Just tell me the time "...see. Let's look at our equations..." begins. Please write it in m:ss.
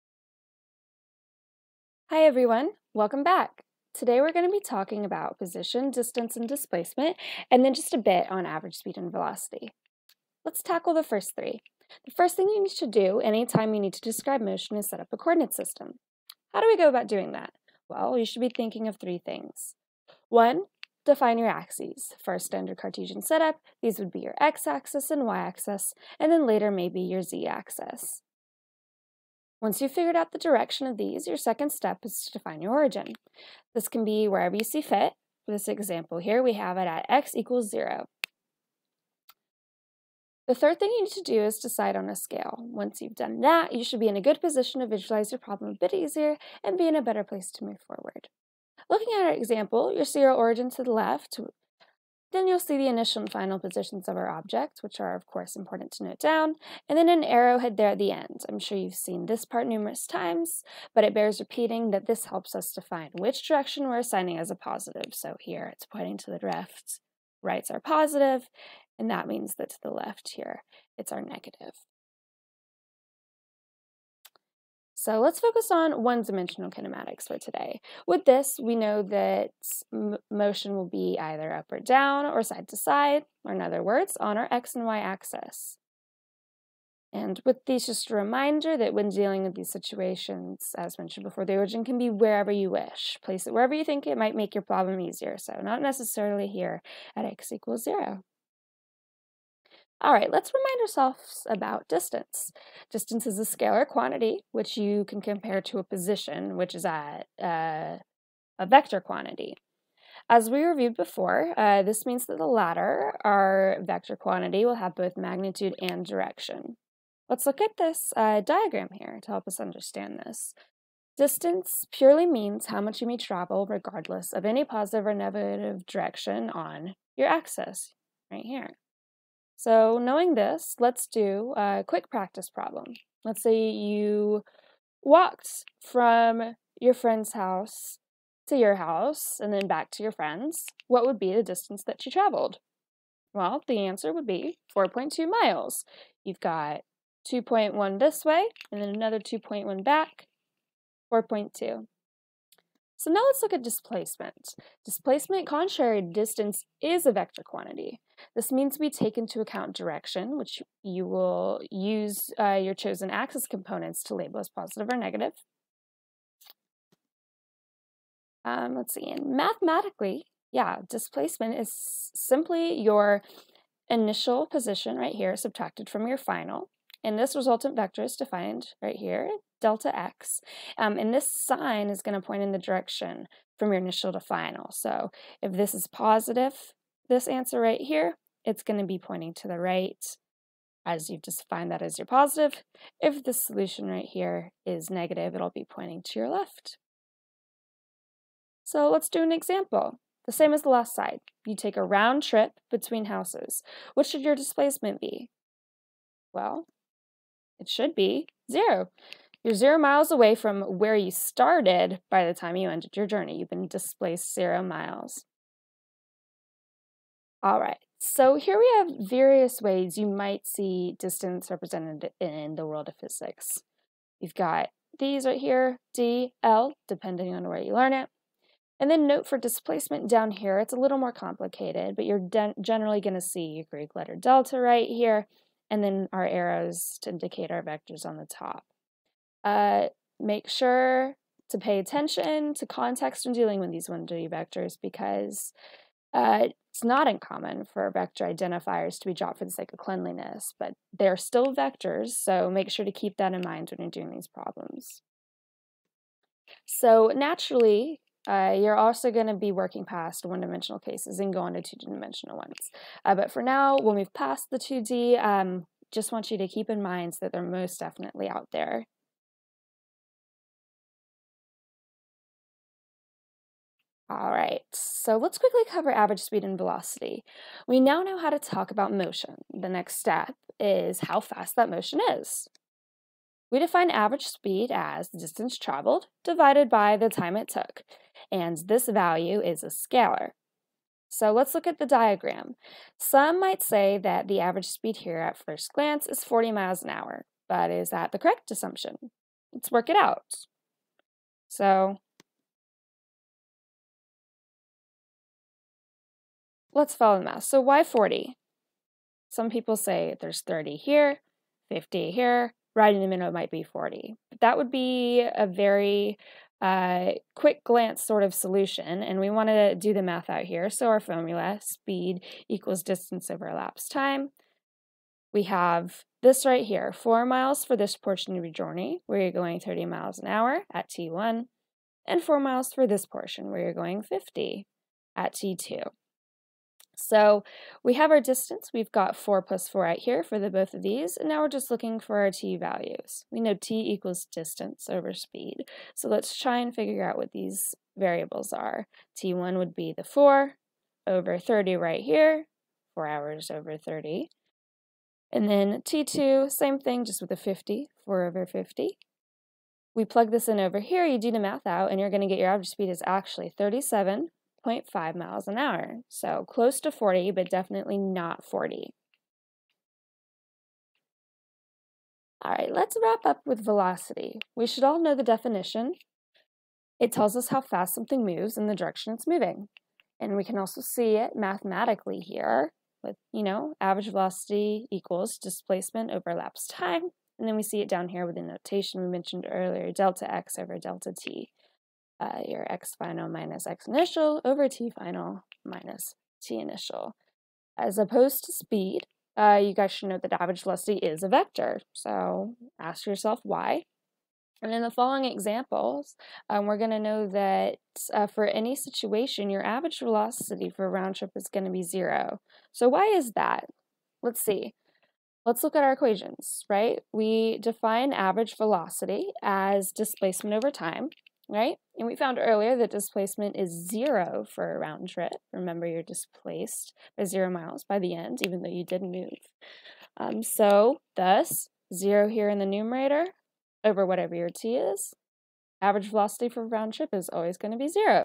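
6:54.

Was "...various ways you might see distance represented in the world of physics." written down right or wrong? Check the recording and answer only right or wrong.
right.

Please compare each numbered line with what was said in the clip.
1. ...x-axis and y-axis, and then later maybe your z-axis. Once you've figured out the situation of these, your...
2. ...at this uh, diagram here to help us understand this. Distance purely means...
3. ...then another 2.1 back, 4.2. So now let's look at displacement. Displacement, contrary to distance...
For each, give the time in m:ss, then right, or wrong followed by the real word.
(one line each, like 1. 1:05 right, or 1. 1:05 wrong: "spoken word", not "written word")
1. 0:24 wrong: "direction", not "situation"
2. 1:57 right
3. 2:28 right.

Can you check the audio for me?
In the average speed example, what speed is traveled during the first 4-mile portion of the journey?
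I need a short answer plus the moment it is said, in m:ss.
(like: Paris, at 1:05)
30 miles an hour, at 5:29.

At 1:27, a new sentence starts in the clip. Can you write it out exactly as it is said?
And with these, just a reminder that when dealing with these situations, as mentioned before, the origin can be wherever you wish.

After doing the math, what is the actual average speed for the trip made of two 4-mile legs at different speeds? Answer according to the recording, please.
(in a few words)
37.5 miles an hour.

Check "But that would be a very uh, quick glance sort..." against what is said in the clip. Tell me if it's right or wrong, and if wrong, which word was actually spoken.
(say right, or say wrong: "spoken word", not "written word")
right.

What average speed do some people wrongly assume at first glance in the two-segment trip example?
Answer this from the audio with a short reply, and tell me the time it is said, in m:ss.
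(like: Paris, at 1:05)
40 miles an hour, at 4:56.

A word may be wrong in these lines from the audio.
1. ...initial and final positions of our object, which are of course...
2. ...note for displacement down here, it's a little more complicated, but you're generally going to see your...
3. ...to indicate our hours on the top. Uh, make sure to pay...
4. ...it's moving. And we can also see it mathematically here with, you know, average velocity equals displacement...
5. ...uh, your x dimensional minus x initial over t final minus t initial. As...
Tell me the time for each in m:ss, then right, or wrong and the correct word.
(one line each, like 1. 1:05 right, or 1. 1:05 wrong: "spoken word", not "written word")
1. 0:52 right
2. 3:49 right
3. 3:57 wrong: "vectors", not "hours"
4. 6:19 right
5. 6:32 wrong: "final", not "dimensional".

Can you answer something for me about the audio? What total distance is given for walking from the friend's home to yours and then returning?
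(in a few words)
4.2 miles.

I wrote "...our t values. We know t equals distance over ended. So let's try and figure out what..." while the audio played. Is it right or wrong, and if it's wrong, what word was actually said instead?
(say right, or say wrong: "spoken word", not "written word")
wrong: "speed", not "ended".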